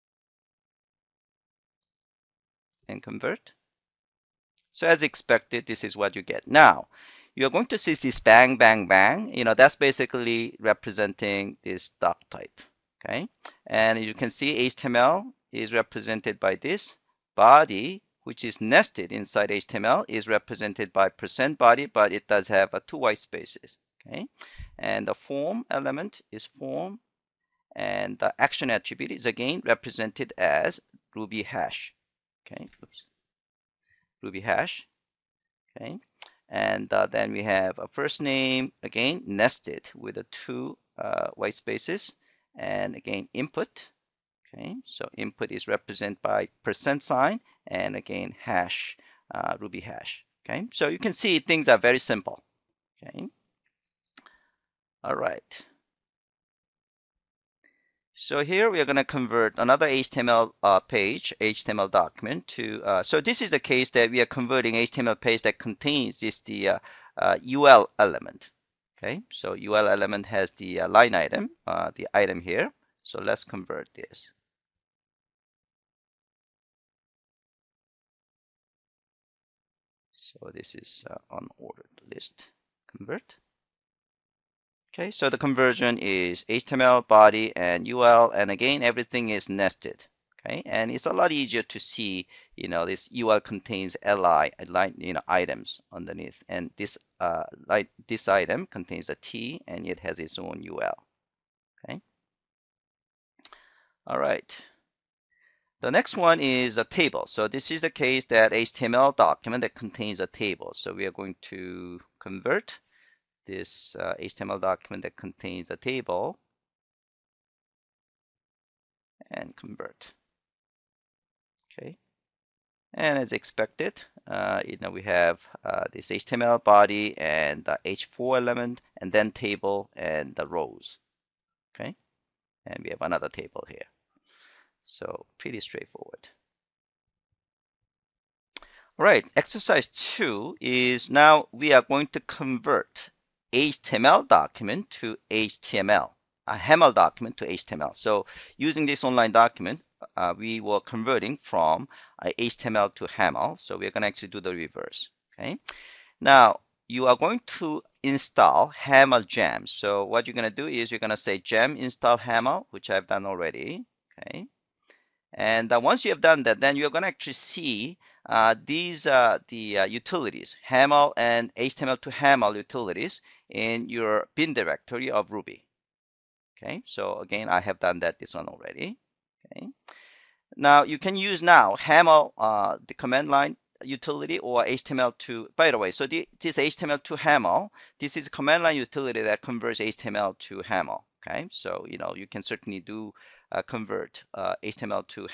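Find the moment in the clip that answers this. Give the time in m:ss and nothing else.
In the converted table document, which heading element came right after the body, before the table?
2:07.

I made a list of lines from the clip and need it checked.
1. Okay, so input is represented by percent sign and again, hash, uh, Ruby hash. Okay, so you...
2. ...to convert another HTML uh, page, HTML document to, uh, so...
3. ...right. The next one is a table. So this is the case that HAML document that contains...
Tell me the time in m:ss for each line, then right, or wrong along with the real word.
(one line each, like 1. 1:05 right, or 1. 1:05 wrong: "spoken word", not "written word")
1. 0:44 right
2. 0:58 right
3. 1:44 wrong: "HTML", not "HAML".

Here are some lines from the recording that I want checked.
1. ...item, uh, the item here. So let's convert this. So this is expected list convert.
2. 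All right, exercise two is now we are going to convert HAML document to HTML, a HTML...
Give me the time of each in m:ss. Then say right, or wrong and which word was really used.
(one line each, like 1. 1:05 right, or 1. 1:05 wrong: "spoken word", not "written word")
1. 1:11 wrong: "unordered", not "expected"
2. 2:18 wrong: "HAML", not "HTML".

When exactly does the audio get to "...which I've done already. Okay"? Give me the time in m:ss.
2:42.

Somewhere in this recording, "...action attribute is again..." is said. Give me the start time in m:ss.
0:28.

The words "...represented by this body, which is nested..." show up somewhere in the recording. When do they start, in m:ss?
0:15.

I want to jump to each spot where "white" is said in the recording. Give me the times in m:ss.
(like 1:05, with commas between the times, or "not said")
0:22, 0:41.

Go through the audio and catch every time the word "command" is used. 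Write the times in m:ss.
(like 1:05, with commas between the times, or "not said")
3:02, 3:08.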